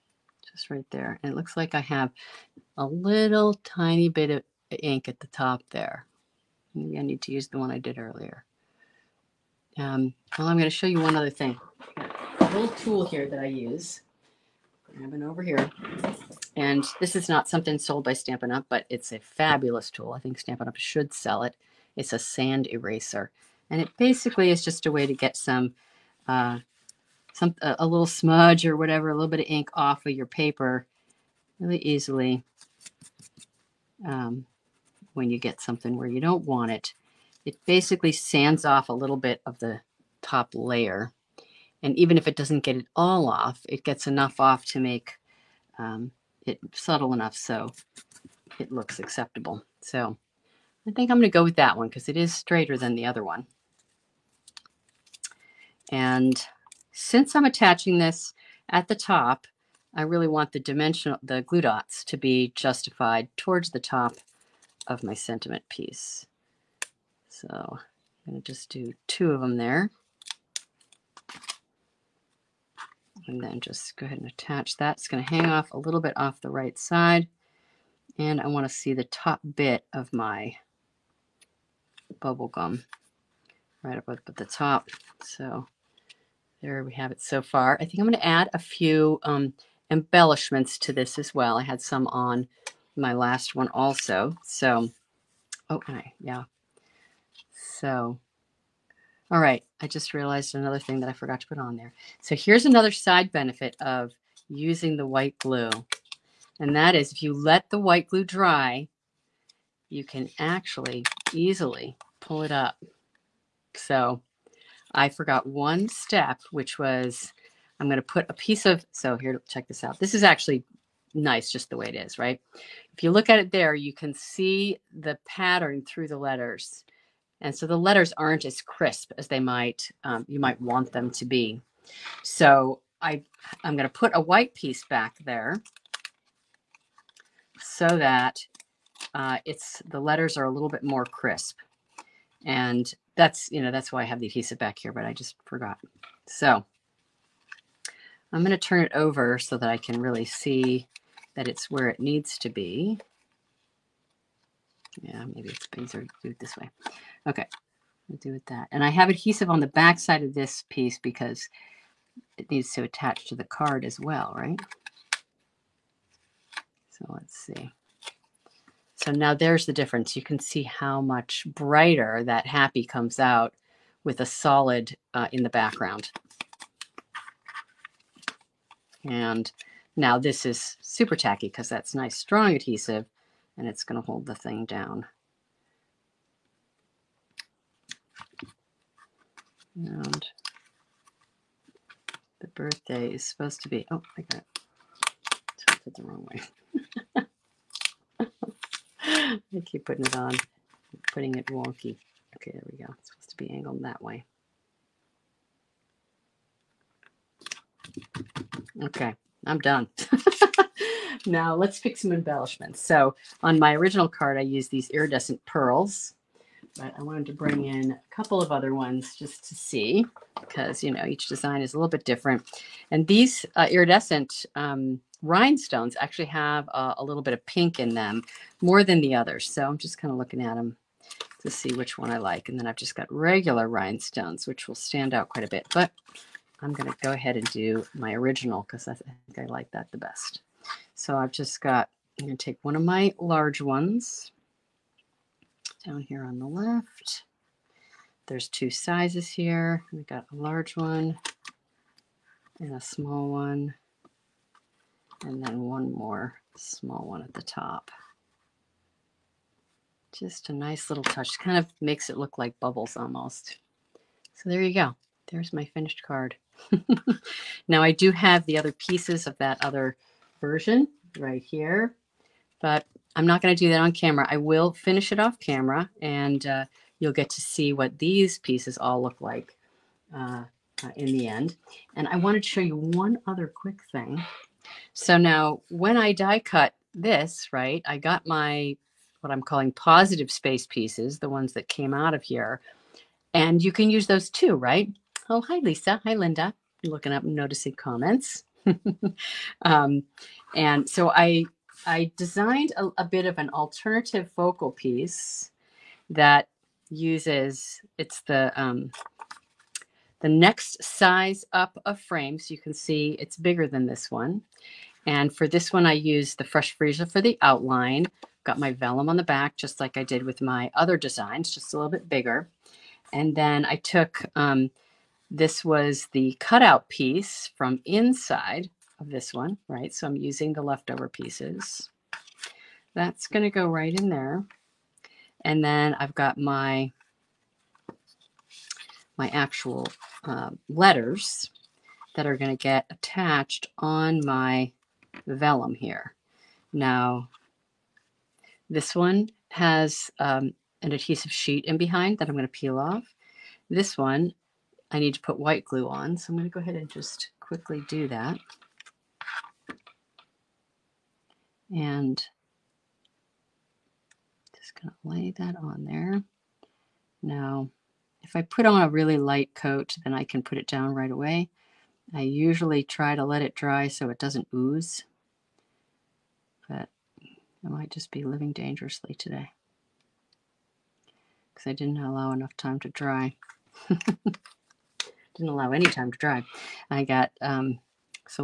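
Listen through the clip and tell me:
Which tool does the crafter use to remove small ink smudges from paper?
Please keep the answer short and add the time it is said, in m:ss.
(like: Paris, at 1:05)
Sand eraser, at 0:22.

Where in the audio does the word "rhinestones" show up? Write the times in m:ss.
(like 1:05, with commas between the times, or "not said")
3:45, 3:53.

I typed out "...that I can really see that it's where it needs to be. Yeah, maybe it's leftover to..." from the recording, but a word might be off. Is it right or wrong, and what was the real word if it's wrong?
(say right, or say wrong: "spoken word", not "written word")
wrong: "better", not "leftover".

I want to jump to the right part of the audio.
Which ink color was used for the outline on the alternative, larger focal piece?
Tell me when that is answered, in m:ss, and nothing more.
5:16.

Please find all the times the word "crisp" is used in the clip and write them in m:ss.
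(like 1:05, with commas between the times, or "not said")
2:08, 2:21.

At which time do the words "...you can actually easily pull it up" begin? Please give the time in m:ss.
1:49.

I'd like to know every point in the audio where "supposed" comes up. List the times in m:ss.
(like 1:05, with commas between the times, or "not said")
3:13, 3:23.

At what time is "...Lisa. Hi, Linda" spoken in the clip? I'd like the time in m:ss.
4:55.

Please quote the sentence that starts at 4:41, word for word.
And I wanted to show you one other quick thing.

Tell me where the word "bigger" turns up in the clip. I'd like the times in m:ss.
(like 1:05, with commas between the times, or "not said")
5:13, 5:22.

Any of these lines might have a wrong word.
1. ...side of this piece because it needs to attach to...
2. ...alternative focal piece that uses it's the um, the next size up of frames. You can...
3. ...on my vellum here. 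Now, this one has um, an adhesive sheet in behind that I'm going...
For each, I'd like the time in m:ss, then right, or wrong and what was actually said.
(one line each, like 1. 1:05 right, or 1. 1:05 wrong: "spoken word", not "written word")
1. 2:39 right
2. 5:03 right
3. 5:43 right.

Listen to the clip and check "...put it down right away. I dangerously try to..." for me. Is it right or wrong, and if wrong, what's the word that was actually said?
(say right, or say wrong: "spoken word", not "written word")
wrong: "usually", not "dangerously".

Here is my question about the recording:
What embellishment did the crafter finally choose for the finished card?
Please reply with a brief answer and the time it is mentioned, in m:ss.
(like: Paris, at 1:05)
Iridescent pearls, at 3:34.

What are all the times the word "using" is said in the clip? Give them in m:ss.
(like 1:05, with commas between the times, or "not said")
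1:44, 5:30.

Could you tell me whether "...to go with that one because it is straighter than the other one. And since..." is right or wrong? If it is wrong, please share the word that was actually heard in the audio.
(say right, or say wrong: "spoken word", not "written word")
right.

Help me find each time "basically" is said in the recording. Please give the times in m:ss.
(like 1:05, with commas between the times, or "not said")
0:23, 0:37.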